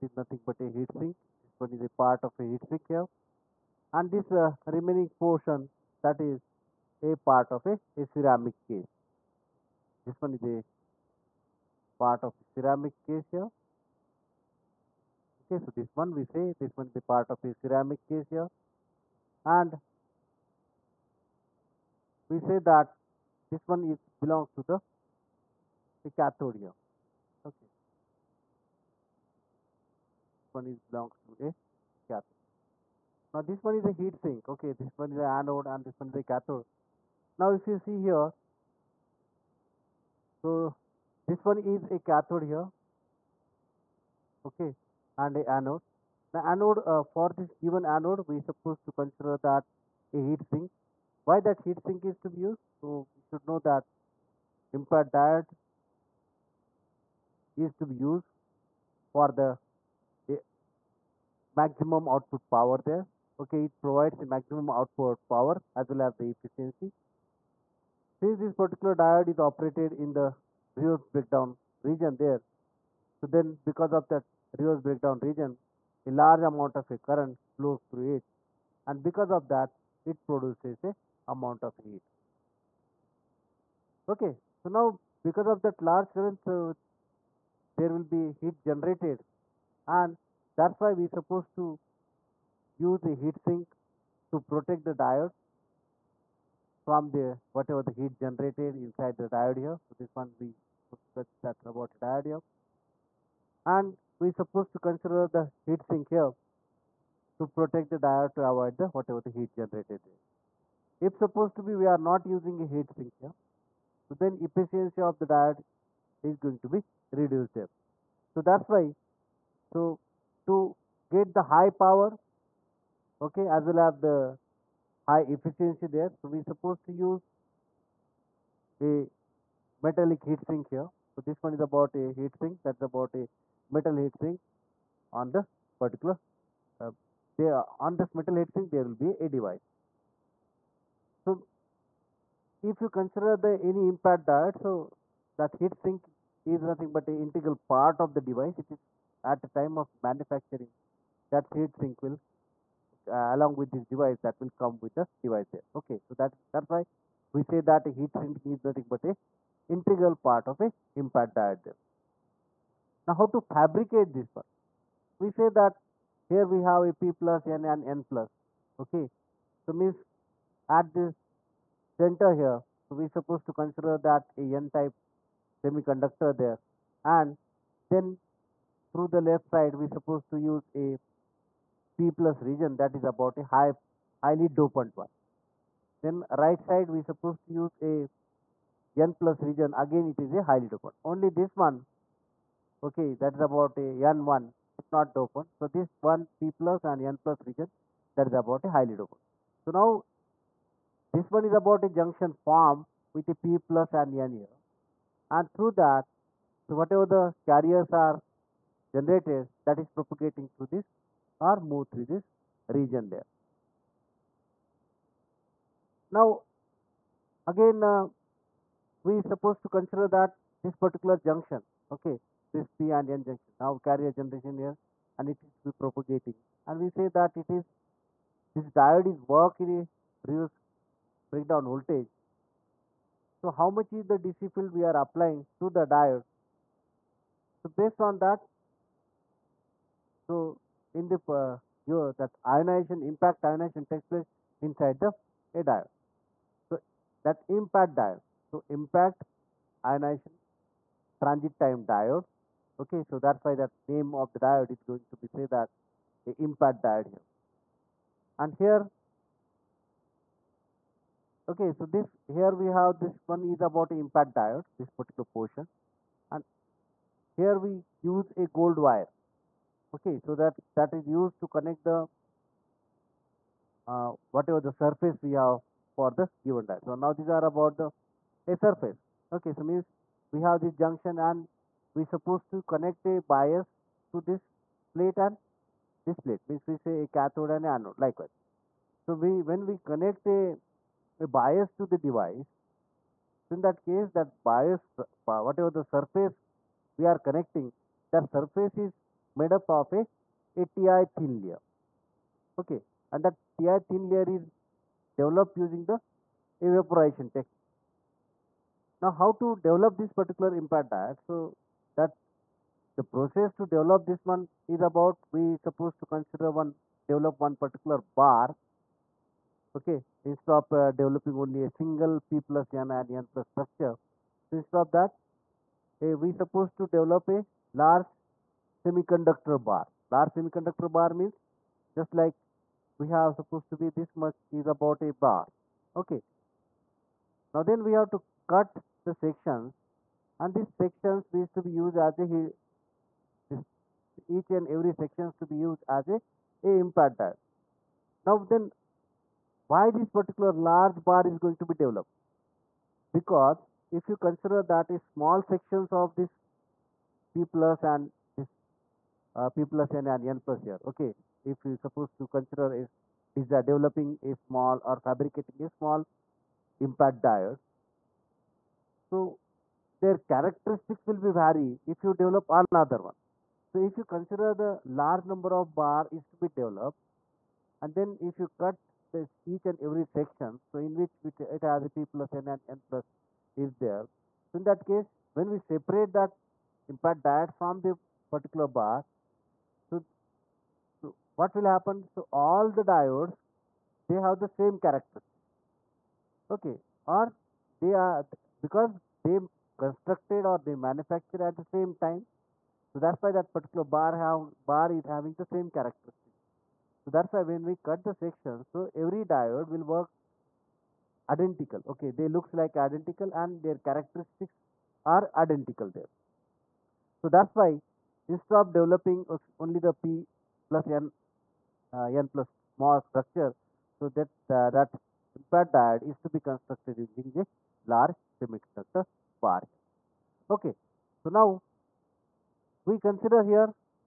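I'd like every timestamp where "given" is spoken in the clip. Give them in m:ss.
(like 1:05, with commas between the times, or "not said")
0:47, 4:36.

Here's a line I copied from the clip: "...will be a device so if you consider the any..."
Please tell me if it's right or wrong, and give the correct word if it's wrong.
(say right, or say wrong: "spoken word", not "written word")
right.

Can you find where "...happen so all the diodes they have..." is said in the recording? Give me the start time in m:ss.
6:31.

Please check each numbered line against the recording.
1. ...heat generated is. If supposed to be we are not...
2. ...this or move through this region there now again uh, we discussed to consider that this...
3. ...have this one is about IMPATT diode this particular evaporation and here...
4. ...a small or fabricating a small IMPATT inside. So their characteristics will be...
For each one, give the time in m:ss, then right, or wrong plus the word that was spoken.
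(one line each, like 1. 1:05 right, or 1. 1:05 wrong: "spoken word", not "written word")
1. 1:49 right
2. 3:30 wrong: "supposed", not "discussed"
3. 4:22 wrong: "portion", not "evaporation"
4. 6:04 wrong: "diode", not "inside".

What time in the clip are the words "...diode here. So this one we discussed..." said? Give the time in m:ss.
1:39.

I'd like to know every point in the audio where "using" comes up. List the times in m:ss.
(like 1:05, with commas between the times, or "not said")
1:52, 5:05, 7:06.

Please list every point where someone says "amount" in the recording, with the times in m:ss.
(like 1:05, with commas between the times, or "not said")
1:16, 1:21.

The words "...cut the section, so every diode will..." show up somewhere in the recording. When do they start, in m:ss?
6:47.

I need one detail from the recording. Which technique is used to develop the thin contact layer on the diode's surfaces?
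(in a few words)
evaporation.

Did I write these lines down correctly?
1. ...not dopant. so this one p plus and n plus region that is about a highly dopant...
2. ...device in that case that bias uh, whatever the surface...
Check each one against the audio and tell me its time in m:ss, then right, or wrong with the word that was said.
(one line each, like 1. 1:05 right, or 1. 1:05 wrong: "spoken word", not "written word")
1. 3:14 right
2. 4:52 right.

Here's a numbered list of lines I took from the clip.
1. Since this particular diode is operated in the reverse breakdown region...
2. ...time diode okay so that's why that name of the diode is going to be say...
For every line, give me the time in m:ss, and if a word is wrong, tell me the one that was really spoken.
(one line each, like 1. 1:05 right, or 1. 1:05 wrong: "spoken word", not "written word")
1. 1:08 right
2. 4:11 right.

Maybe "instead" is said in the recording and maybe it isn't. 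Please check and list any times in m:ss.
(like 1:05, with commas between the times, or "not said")
5:20, 5:24, 6:58.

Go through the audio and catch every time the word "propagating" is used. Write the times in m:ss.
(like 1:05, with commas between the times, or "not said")
3:29, 3:45.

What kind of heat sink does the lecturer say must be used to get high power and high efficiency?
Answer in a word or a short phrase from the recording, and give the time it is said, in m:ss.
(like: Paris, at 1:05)
metallic heat sink, at 2:09.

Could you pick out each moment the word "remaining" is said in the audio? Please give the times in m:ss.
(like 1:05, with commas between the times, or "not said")
0:04.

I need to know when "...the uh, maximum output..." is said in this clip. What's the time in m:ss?
0:59.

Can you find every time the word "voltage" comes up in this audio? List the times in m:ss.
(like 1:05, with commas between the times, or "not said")
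3:51.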